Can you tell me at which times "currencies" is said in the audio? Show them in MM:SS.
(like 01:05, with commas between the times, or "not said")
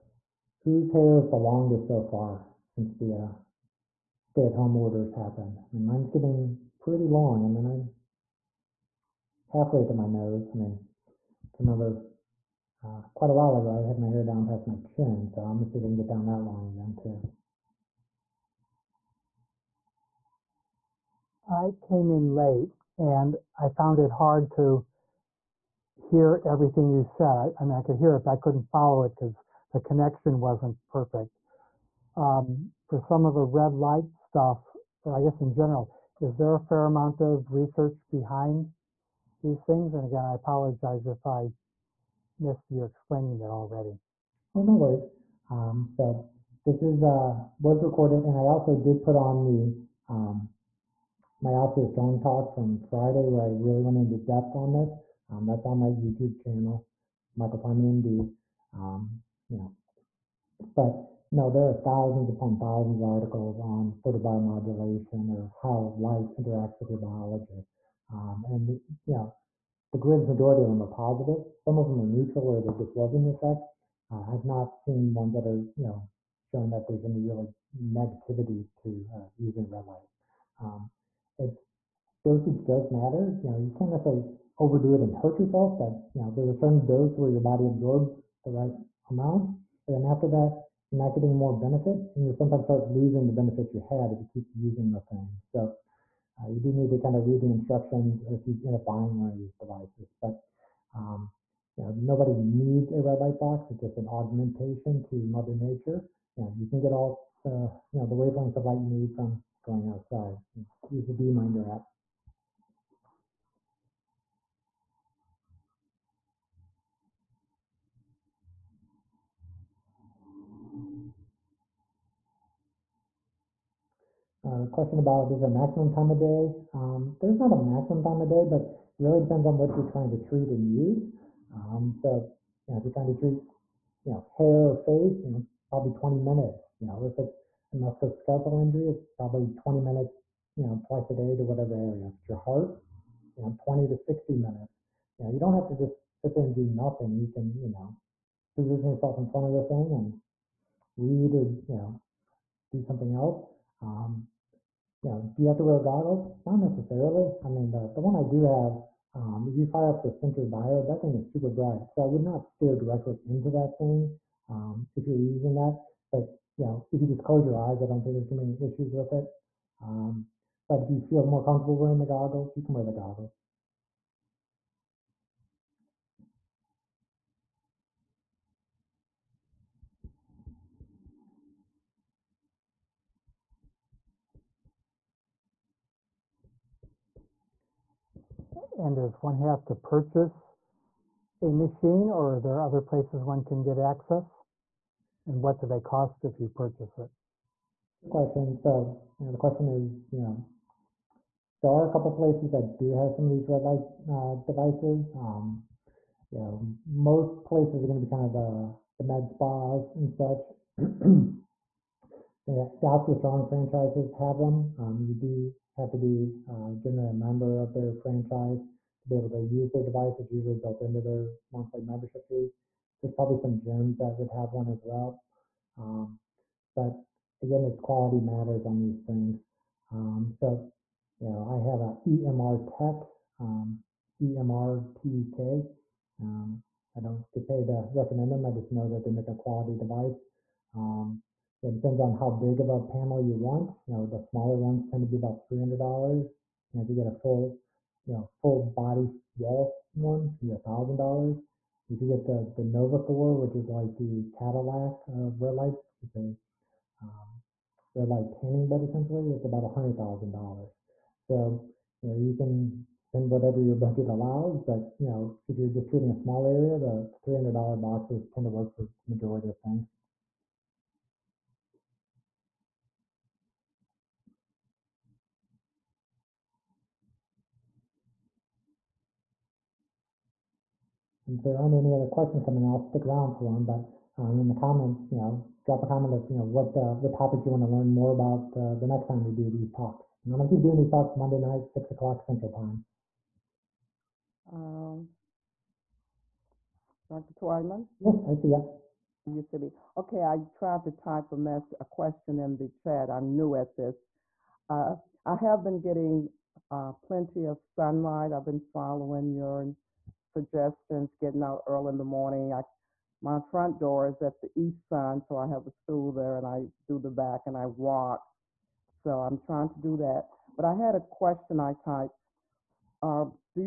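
not said.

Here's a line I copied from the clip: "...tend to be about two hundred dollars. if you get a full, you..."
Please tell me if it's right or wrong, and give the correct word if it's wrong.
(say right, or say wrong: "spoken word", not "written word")
wrong: "three", not "two".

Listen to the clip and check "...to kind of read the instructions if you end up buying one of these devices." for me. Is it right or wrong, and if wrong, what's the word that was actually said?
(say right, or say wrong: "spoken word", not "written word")
right.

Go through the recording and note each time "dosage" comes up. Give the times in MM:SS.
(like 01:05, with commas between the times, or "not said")
01:22.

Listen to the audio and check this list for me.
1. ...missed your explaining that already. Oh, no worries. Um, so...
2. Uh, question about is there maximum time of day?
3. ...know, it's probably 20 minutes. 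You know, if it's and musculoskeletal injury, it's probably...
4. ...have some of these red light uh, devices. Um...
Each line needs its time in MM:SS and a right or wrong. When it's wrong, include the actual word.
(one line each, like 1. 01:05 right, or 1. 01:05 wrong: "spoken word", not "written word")
1. 00:42 right
2. 02:04 right
3. 02:15 right
4. 03:22 right.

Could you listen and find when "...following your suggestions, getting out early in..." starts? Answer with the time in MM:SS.
05:08.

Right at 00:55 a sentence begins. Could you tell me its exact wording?
Um, that's on my YouTube channel, Michael Twyman MD.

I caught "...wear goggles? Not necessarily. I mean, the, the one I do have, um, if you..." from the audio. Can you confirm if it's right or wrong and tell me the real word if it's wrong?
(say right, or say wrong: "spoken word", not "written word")
right.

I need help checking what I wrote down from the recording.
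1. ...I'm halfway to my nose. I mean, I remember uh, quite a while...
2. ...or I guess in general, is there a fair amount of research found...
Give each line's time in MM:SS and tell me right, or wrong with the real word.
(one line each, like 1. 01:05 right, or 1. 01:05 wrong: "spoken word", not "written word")
1. 00:07 right
2. 00:35 wrong: "behind", not "found".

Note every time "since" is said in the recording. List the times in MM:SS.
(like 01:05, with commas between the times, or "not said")
00:02.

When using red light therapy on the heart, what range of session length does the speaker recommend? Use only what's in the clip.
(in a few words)
20 to 60 minutes.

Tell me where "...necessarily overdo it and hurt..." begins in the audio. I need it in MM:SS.
01:23.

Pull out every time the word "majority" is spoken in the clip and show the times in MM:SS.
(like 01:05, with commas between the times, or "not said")
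01:10, 04:29.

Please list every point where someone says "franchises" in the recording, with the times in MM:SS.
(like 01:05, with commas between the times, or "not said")
03:33, 03:37.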